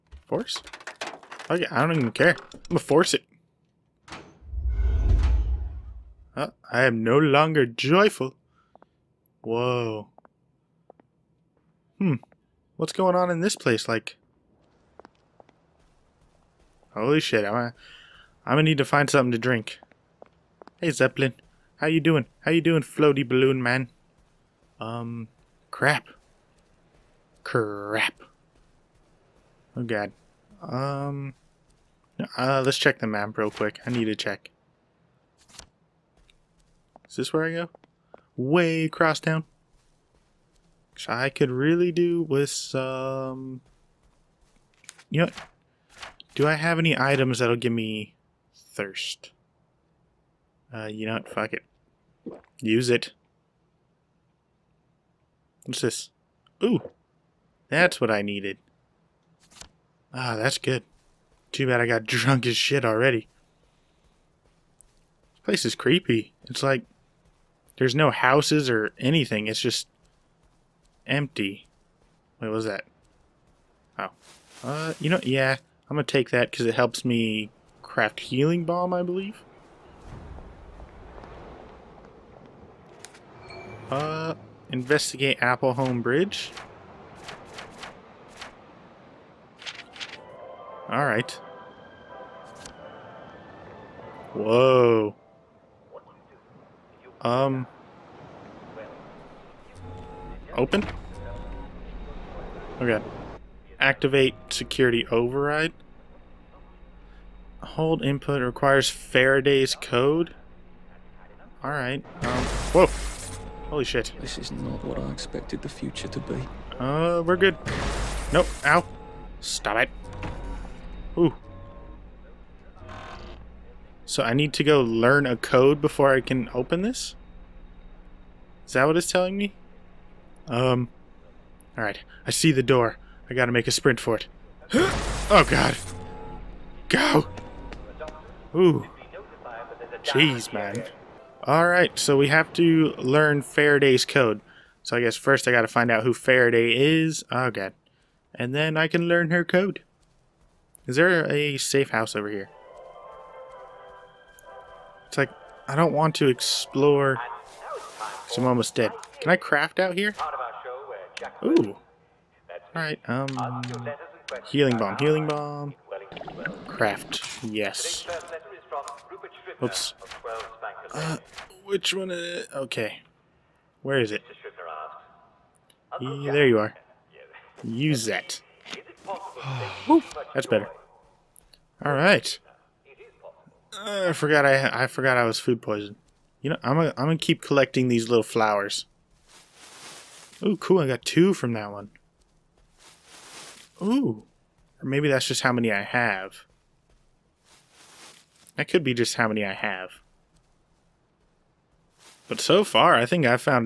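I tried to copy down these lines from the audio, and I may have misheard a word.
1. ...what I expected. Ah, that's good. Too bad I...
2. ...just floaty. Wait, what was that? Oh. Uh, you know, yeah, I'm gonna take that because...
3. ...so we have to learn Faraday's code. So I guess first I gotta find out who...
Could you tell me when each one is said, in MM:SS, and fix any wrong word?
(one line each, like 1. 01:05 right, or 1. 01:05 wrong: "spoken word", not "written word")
1. 00:58 wrong: "needed", not "expected"
2. 01:09 wrong: "empty", not "floaty"
3. 02:21 right.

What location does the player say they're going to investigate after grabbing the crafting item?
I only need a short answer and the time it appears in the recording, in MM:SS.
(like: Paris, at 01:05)
Apple Home Bridge, at 01:25.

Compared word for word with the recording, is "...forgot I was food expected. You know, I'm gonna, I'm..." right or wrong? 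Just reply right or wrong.
wrong.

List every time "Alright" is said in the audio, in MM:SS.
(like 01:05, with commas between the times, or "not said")
01:30, 01:51, 02:11, 02:21, 02:42, 03:01.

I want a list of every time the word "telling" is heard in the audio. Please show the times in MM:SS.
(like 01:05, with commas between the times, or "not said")
02:09.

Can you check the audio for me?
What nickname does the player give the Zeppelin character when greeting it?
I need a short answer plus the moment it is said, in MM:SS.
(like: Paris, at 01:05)
Floaty balloon man, at 00:22.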